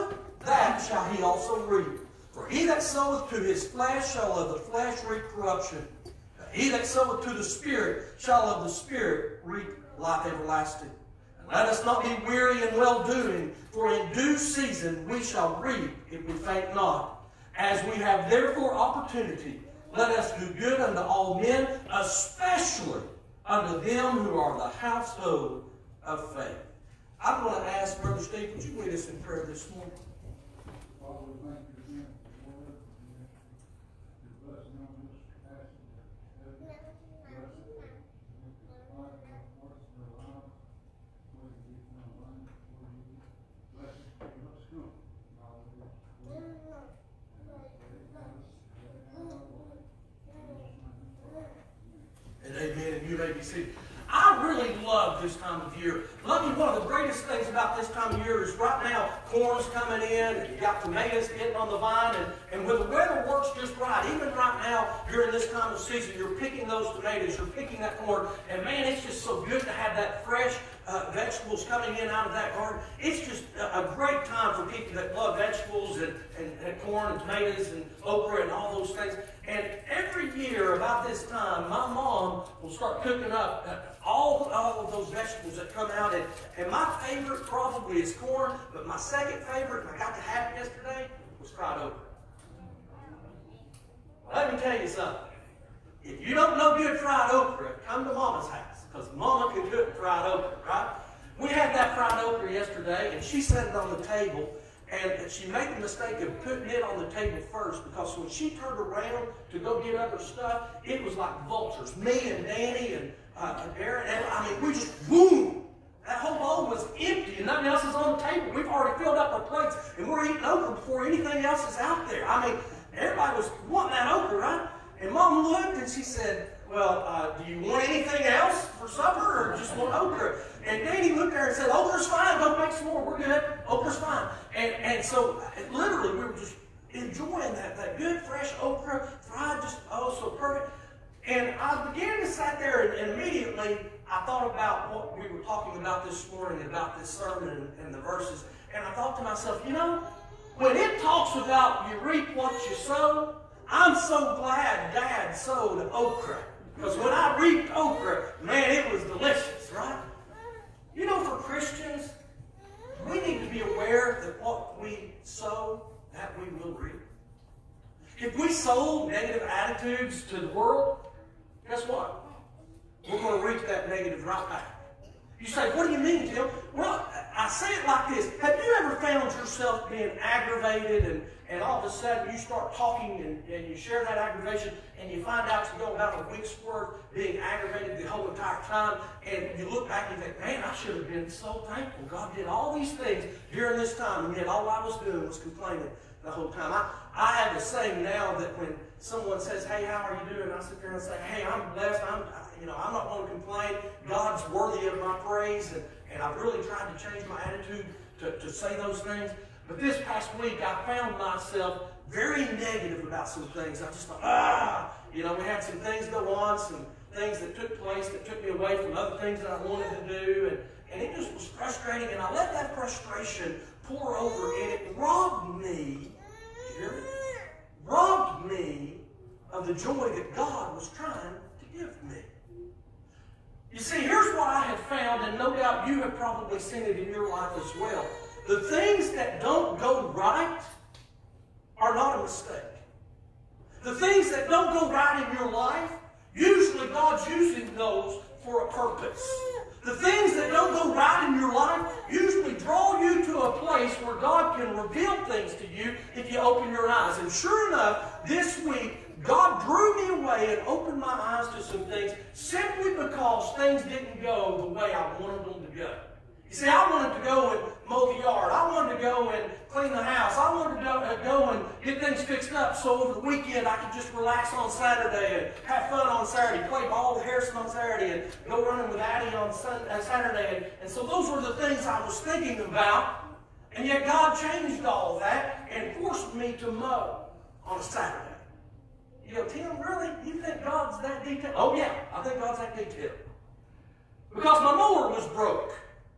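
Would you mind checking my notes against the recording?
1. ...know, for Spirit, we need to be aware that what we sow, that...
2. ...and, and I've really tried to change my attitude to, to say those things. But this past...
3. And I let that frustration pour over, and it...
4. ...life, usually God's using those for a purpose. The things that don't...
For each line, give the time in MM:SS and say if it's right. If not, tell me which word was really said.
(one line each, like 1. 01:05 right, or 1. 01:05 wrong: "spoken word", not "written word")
1. 02:41 wrong: "Christians", not "Spirit"
2. 03:25 right
3. 03:42 right
4. 04:05 right.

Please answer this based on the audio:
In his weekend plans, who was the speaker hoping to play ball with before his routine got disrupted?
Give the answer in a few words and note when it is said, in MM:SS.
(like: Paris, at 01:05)
Harrison, at 04:37.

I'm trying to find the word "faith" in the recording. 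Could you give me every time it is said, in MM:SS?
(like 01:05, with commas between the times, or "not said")
00:26.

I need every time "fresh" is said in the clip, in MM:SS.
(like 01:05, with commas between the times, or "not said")
01:10, 02:18.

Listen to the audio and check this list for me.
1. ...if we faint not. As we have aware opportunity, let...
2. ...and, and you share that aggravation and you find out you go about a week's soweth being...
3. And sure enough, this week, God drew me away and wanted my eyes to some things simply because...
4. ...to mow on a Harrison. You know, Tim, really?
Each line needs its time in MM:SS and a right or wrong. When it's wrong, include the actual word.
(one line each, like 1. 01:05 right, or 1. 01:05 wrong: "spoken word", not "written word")
1. 00:16 wrong: "therefore", not "aware"
2. 03:03 wrong: "worth", not "soweth"
3. 04:17 wrong: "opened", not "wanted"
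4. 04:46 wrong: "Saturday", not "Harrison".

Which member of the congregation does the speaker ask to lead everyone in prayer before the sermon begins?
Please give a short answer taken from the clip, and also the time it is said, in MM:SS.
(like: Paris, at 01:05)
Brother Steve, at 00:28.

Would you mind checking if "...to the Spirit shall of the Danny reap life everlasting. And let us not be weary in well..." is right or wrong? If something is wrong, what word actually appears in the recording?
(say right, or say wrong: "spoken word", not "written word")
wrong: "Spirit", not "Danny".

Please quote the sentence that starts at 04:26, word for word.
You see, I wanted to go and mow the yard.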